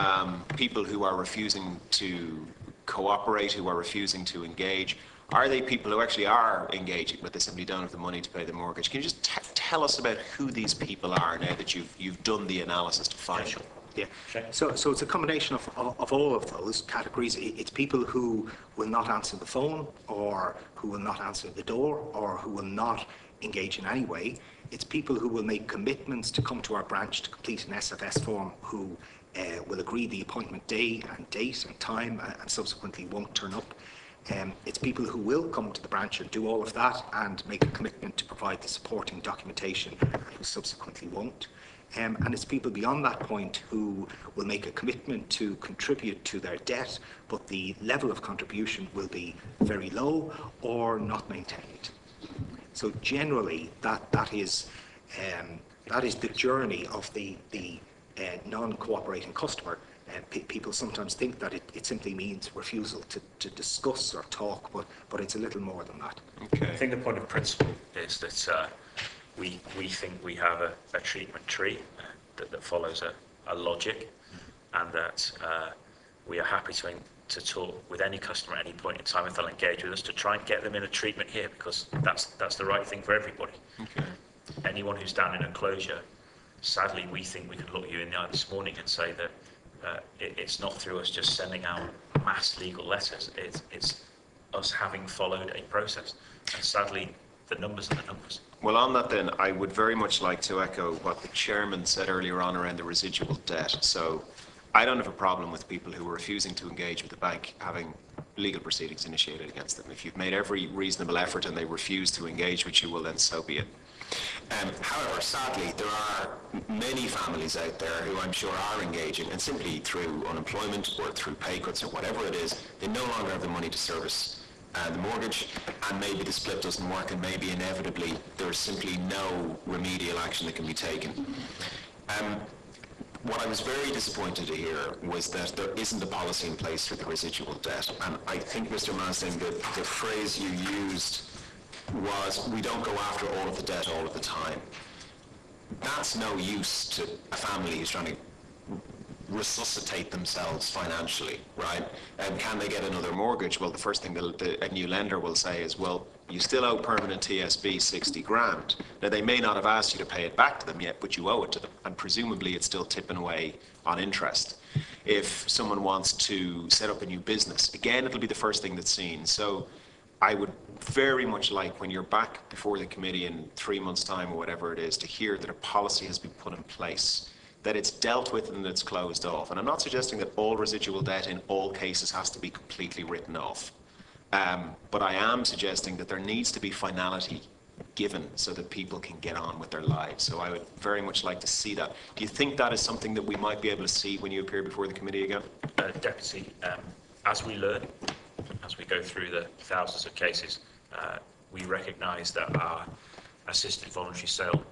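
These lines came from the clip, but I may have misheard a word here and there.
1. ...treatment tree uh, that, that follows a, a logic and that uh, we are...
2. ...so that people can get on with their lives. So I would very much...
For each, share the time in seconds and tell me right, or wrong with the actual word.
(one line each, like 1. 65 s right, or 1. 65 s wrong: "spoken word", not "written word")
1. 70 s right
2. 188 s right.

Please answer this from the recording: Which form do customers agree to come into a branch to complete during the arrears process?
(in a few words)
SFS form.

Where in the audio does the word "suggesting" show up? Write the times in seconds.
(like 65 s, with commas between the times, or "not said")
179 s, 185 s.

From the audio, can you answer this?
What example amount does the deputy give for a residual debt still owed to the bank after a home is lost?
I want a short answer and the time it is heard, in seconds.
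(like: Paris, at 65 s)
60 grand, at 157 s.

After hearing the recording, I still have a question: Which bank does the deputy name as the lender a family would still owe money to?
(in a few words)
Permanent TSB.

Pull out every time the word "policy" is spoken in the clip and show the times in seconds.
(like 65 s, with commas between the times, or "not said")
136 s, 175 s.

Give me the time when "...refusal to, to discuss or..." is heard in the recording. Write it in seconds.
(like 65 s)
62 s.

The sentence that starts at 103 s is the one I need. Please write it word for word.
So I don't have a problem with people who are refusing to engage with the bank having legal proceedings initiated against them.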